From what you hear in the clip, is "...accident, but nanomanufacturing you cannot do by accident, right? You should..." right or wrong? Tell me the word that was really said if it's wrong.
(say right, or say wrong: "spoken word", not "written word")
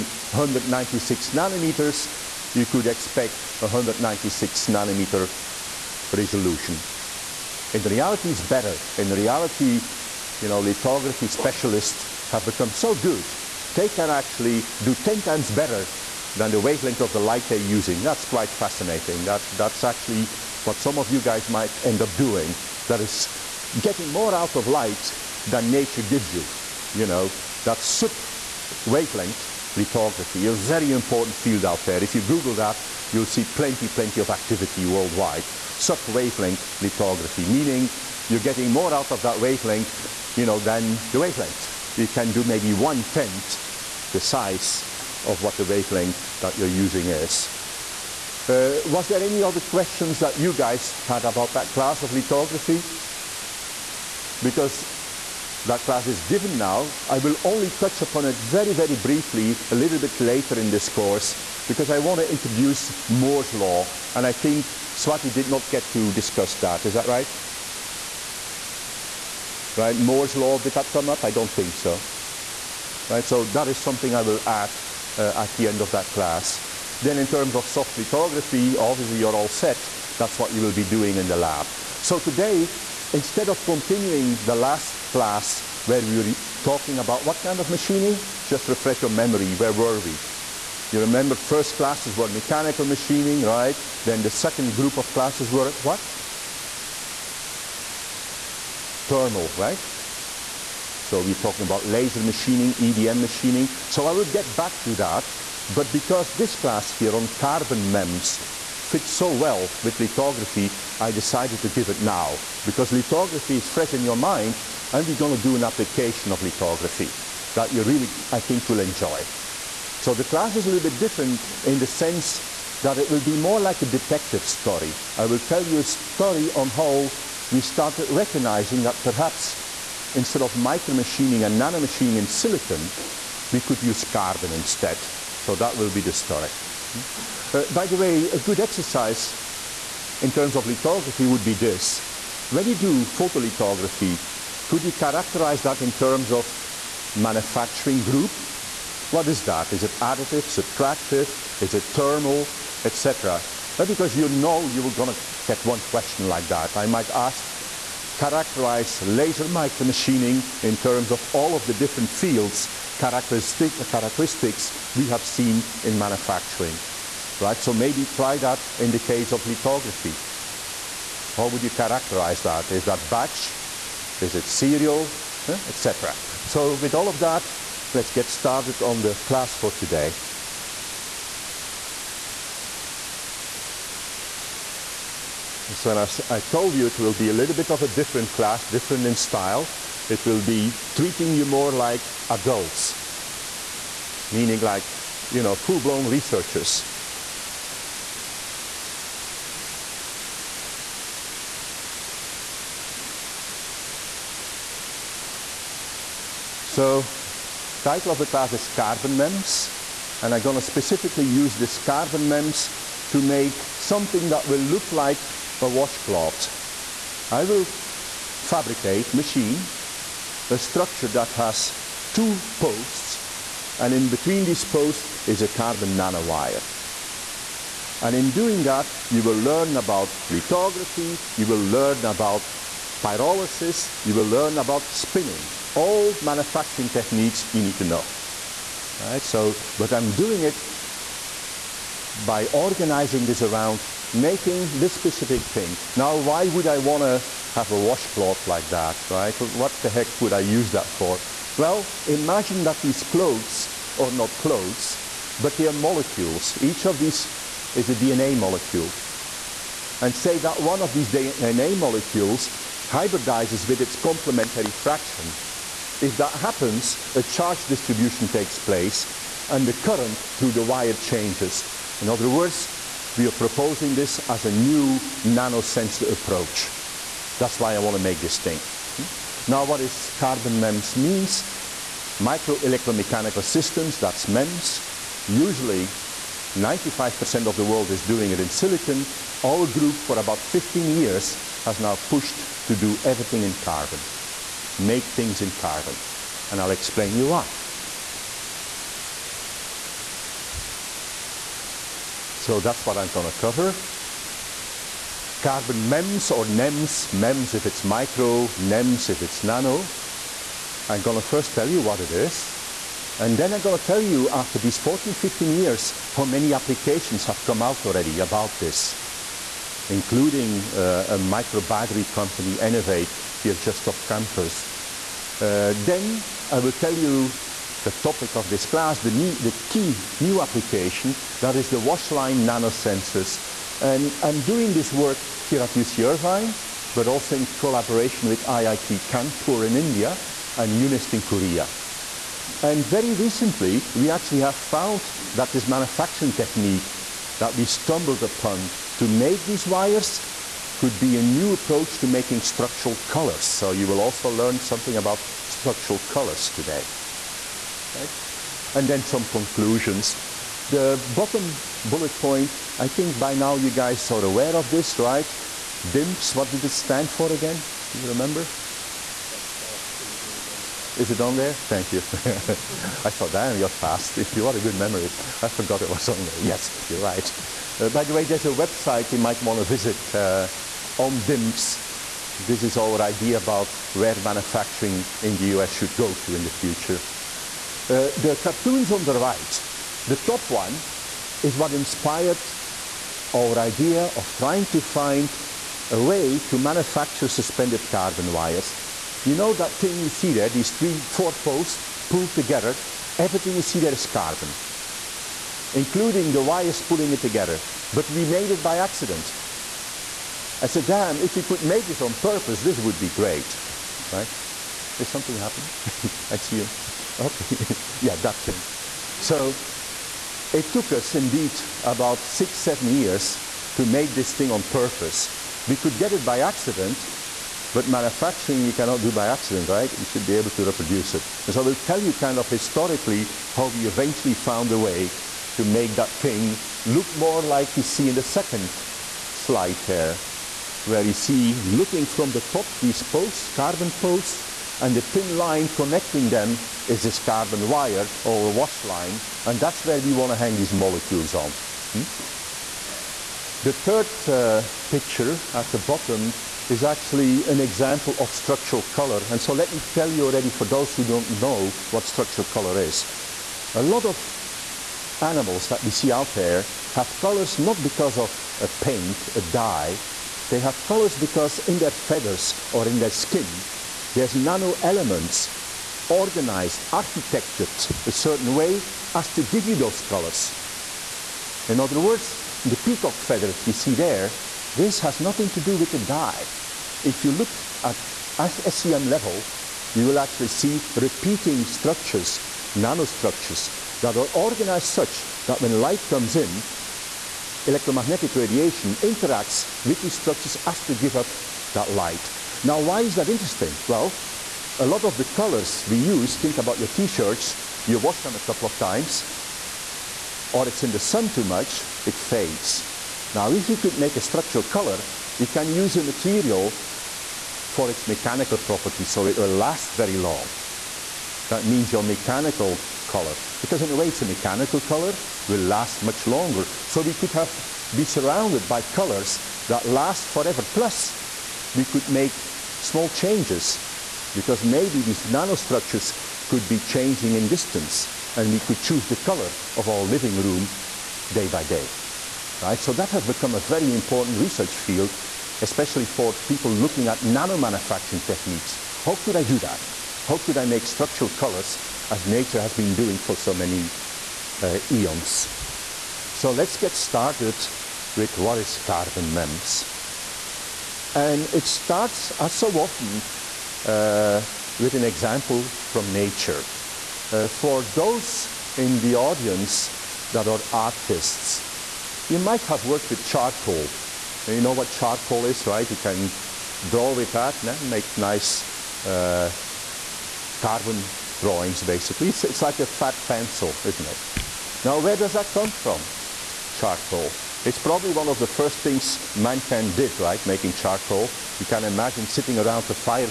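wrong: "manufacturing", not "nanomanufacturing".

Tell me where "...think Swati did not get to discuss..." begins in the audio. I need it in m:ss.
1:04.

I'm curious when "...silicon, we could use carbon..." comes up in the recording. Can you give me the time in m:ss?
2:12.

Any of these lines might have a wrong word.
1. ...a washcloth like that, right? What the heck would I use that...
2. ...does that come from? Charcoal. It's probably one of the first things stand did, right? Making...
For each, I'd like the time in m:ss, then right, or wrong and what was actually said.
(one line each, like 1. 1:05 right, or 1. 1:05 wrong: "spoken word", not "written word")
1. 4:07 right
2. 9:45 wrong: "mankind", not "stand".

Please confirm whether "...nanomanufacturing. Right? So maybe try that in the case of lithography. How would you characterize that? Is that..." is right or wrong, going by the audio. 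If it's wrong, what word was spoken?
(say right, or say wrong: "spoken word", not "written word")
wrong: "manufacturing", not "nanomanufacturing".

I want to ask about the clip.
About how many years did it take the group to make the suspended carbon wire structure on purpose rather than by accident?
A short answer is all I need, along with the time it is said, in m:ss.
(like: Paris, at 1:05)
six, seven years, at 7:02.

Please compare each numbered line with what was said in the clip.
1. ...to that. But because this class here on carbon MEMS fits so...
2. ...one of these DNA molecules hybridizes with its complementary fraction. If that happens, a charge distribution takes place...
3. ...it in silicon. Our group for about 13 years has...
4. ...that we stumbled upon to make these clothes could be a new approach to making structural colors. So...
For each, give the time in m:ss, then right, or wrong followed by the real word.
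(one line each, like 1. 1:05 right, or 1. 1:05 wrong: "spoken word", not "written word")
1. 1:44 right
2. 4:20 right
3. 4:48 wrong: "15", not "13"
4. 5:47 wrong: "wires", not "clothes".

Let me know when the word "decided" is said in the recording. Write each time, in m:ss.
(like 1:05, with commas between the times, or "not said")
1:51.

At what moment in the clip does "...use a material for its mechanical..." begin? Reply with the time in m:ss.
8:35.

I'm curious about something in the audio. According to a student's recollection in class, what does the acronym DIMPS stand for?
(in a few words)
Desktop Integrated Manufacturing.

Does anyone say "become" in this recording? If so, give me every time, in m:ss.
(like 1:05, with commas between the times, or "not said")
0:12, 9:03.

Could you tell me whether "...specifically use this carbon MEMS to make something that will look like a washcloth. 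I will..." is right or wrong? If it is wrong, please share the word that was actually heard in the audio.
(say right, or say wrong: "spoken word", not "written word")
right.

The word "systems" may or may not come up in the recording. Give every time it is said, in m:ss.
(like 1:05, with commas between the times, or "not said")
4:43.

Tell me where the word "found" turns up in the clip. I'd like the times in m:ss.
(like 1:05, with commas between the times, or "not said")
5:44, 7:14.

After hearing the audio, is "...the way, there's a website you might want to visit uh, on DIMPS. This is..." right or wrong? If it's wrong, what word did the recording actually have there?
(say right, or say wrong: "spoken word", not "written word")
right.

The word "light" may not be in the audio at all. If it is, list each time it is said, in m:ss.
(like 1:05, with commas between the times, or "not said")
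0:17, 0:24, 8:15, 8:21.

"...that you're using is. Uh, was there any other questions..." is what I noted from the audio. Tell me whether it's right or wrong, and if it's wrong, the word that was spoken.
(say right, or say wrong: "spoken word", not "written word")
right.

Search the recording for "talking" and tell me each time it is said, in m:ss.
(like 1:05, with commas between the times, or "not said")
1:26, 1:41.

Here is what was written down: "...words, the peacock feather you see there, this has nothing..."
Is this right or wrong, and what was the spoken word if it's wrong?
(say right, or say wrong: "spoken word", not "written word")
right.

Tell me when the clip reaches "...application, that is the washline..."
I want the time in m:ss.
5:30.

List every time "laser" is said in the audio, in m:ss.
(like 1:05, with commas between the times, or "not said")
1:41, 2:39.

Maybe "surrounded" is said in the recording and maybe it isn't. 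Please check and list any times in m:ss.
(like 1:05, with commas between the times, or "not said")
8:48.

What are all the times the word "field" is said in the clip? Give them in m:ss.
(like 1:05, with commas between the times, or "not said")
0:31, 2:42, 9:04.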